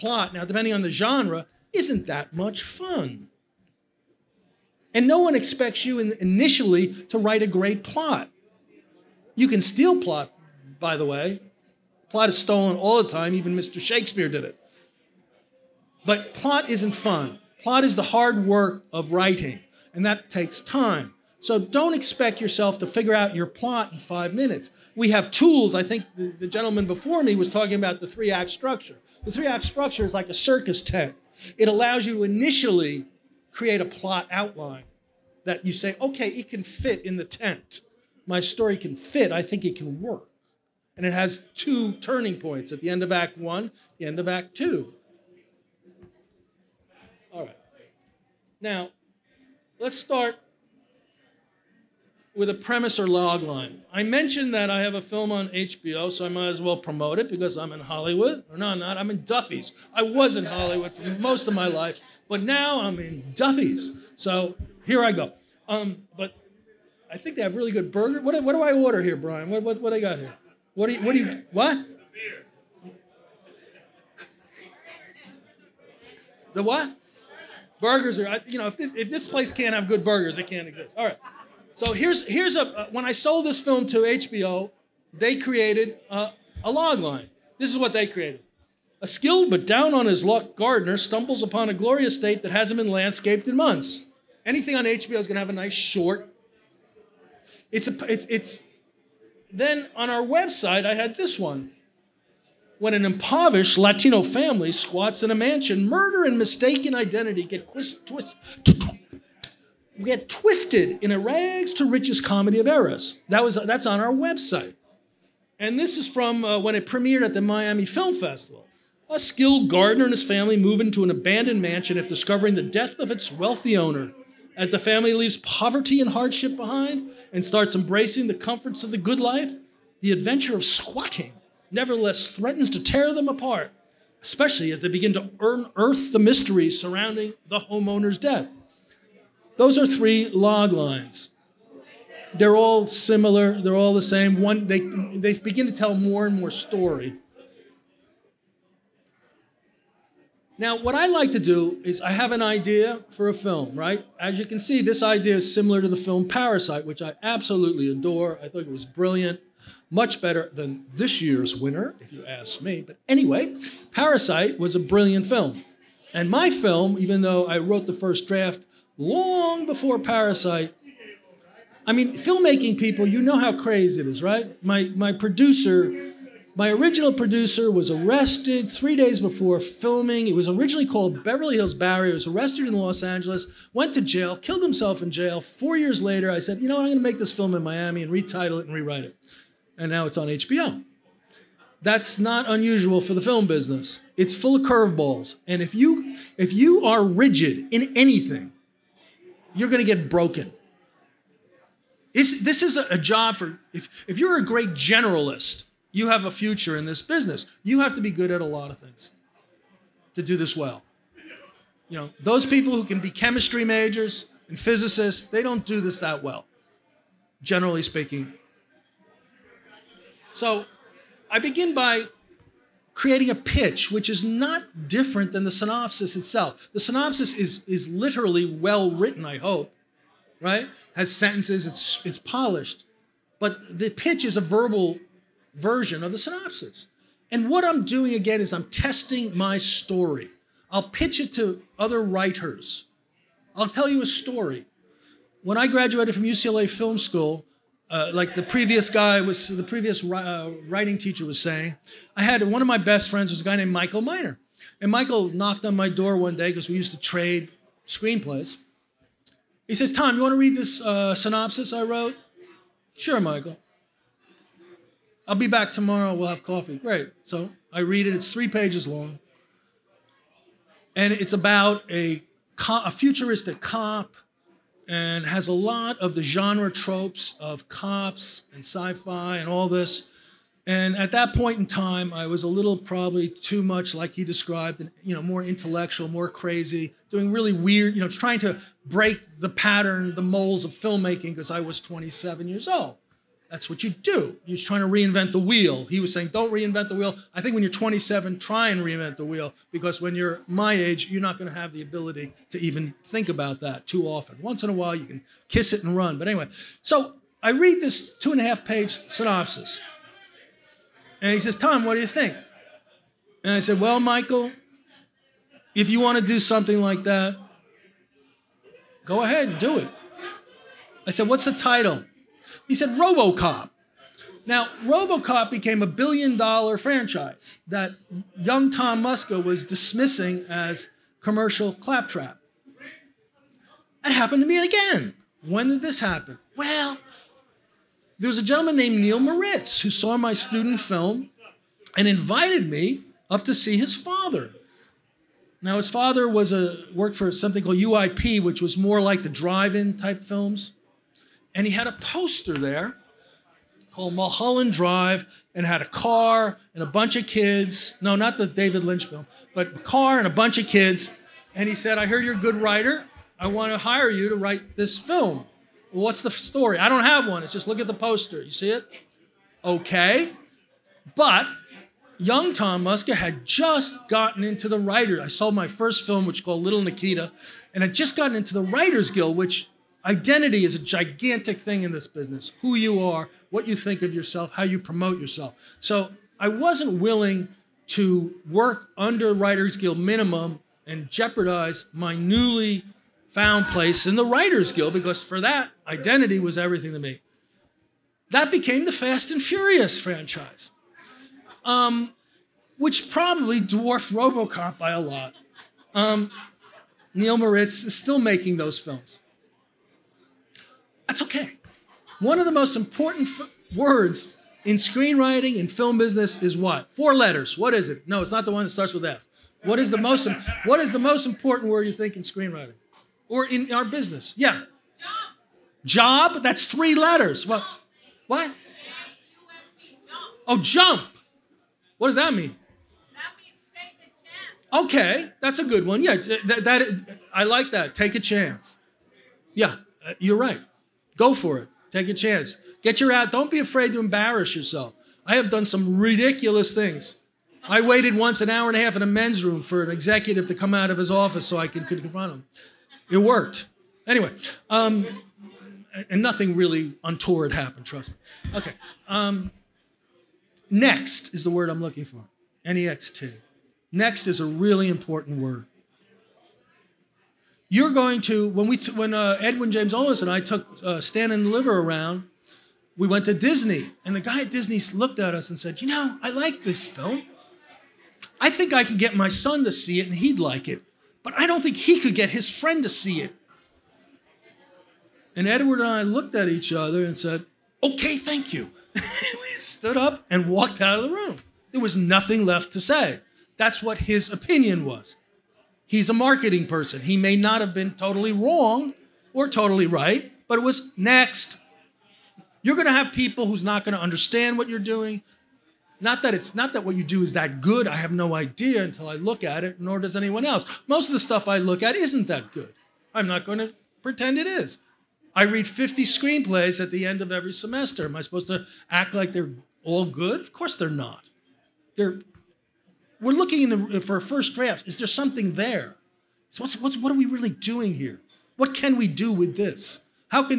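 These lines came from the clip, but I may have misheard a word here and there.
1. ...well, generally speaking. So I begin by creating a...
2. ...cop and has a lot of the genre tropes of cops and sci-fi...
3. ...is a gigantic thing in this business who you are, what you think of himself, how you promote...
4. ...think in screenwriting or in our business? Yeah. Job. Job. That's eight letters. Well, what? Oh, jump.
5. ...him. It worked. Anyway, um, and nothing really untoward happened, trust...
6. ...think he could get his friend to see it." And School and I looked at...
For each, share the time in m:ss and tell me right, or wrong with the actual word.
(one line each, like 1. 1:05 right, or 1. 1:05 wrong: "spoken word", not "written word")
1. 3:36 right
2. 4:33 right
3. 6:20 wrong: "yourself", not "himself"
4. 7:01 wrong: "three", not "eight"
5. 7:32 right
6. 8:01 wrong: "Edward", not "School".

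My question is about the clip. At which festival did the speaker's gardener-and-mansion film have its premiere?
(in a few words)
Miami Film Festival.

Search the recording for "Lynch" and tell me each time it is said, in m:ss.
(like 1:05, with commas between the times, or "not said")
5:58.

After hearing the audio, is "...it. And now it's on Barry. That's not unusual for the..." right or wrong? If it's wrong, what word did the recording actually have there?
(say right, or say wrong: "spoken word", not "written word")
wrong: "HBO", not "Barry".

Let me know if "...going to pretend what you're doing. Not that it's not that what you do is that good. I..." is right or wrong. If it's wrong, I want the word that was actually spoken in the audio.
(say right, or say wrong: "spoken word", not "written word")
wrong: "understand", not "pretend".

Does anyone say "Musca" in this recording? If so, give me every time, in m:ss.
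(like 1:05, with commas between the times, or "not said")
5:29, 6:12.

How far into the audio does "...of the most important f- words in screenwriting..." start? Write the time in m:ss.
6:52.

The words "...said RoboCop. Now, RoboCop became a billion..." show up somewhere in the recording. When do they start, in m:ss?
5:22.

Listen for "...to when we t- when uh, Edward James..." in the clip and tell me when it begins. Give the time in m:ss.
7:48.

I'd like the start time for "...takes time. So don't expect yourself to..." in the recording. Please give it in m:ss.
0:20.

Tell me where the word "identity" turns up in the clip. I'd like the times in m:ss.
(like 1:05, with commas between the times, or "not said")
1:46, 6:20, 6:35.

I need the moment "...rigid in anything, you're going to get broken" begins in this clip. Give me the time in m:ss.
3:17.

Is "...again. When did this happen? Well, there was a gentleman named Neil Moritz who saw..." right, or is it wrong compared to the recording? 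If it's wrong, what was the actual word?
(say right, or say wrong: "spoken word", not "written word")
right.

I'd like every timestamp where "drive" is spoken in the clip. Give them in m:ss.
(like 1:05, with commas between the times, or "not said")
5:49, 5:54.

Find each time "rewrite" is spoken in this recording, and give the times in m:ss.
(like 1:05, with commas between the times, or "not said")
3:08.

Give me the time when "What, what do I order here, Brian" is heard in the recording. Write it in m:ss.
1:08.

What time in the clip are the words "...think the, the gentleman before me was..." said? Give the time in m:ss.
0:25.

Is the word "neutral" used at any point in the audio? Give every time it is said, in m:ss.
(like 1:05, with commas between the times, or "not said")
not said.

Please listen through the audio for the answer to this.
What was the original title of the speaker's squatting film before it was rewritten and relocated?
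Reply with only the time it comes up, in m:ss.
3:01.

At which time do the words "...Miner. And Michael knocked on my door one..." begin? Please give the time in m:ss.
4:14.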